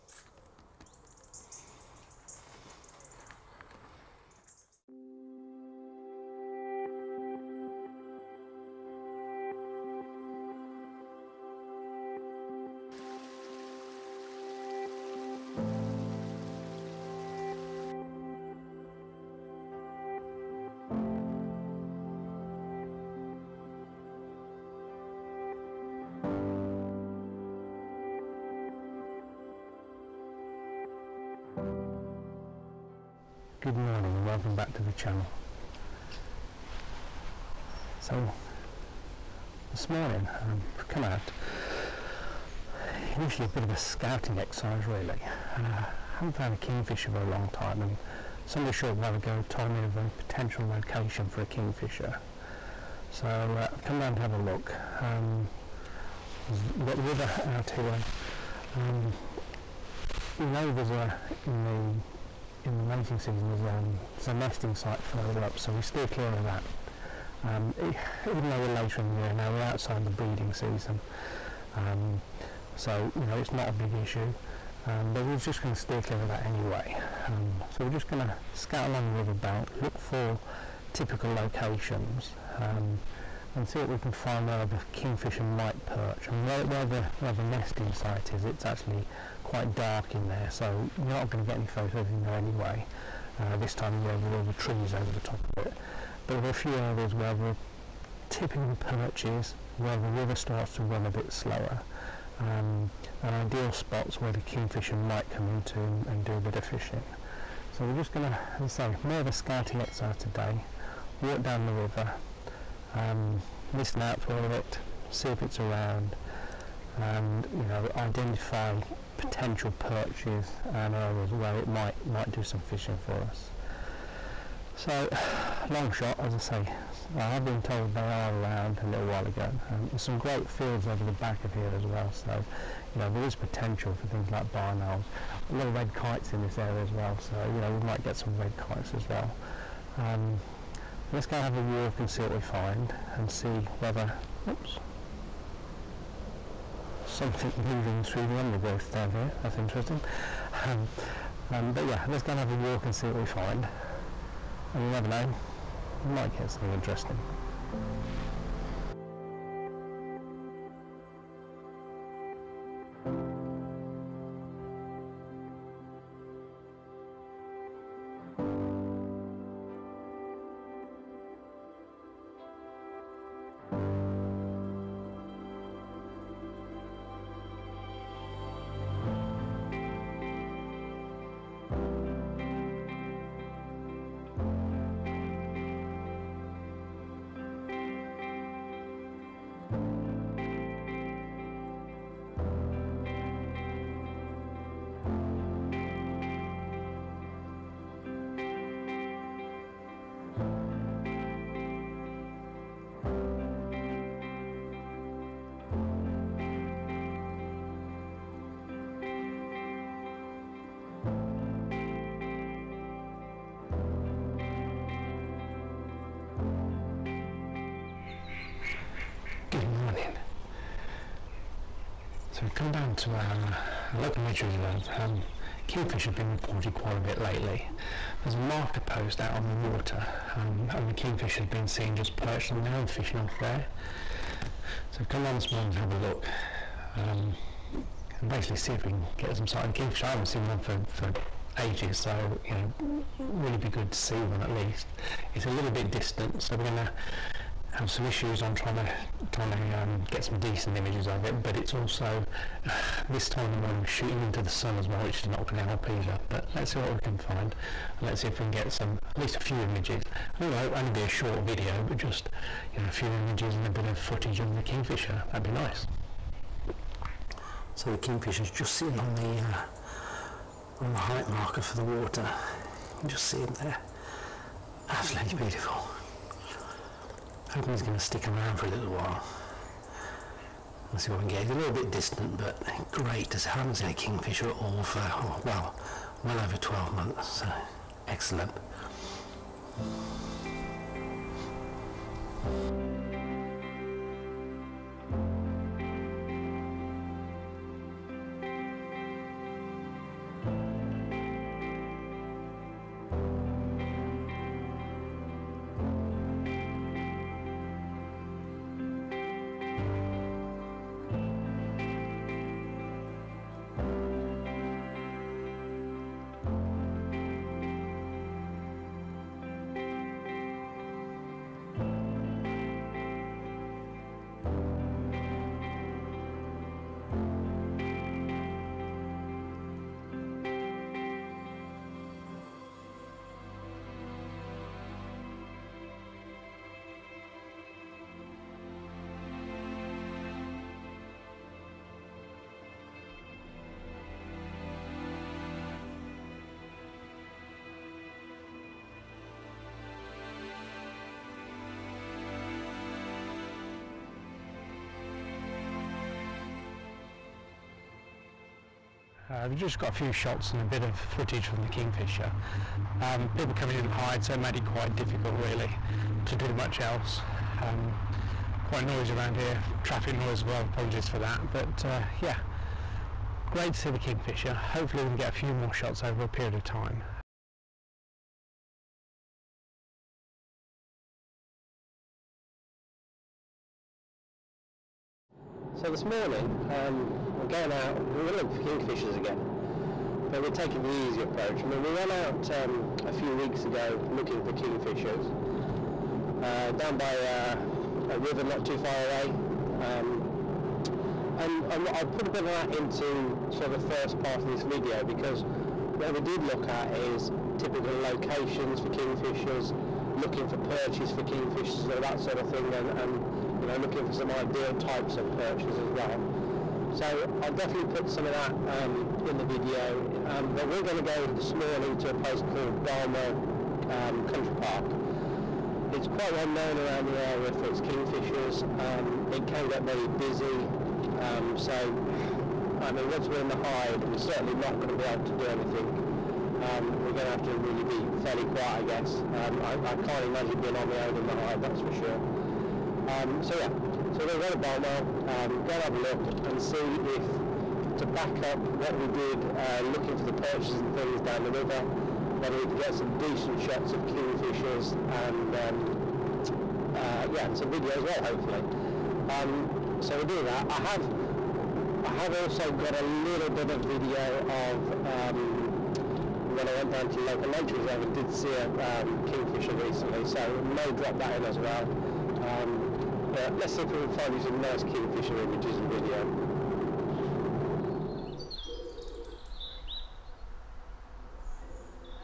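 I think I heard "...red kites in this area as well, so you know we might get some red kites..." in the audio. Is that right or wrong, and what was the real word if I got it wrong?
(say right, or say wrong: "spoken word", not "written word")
right.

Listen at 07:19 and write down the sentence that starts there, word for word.
I, I can't imagine being on my own in the hide, that's for sure.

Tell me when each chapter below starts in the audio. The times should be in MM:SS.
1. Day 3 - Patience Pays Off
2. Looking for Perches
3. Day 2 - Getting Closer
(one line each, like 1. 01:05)
1. 06:17
2. 02:38
3. 03:30.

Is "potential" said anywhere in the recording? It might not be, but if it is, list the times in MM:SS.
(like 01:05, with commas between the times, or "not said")
00:50, 01:59, 02:13.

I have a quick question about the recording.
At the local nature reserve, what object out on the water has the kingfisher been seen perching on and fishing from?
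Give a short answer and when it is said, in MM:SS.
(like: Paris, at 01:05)
Marker post, at 03:48.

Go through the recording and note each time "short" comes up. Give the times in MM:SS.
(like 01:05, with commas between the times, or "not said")
00:48, 04:21.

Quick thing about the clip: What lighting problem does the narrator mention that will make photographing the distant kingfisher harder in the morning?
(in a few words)
Shooting into the sun.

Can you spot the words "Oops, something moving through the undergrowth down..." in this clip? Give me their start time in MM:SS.
02:24.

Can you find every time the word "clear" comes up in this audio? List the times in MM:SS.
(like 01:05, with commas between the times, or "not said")
01:06, 01:16.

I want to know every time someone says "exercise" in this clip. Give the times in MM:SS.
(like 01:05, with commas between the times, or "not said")
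00:44, 01:49.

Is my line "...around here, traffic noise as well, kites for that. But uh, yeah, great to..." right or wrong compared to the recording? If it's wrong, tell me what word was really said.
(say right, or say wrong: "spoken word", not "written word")
wrong: "apologies", not "kites".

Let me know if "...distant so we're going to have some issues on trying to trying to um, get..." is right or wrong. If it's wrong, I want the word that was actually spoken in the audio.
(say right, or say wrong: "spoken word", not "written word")
right.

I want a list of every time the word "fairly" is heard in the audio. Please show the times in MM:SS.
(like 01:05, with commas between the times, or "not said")
07:18.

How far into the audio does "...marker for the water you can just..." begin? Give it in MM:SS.
04:31.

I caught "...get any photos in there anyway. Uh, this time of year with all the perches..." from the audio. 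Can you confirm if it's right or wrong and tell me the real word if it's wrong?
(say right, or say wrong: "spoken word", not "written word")
wrong: "trees", not "perches".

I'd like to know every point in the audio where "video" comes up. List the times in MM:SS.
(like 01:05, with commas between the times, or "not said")
04:21, 06:44, 06:59, 07:37, 07:43, 07:55.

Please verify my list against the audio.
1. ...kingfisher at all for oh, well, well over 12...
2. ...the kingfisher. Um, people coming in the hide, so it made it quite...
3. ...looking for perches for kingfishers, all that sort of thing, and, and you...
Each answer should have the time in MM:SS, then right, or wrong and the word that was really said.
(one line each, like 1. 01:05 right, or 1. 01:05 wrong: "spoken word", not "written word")
1. 04:43 right
2. 06:01 right
3. 06:50 right.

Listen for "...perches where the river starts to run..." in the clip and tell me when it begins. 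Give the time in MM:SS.
01:38.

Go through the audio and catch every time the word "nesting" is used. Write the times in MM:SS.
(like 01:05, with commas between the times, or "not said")
01:04, 01:27.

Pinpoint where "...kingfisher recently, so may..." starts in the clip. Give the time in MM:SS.
07:49.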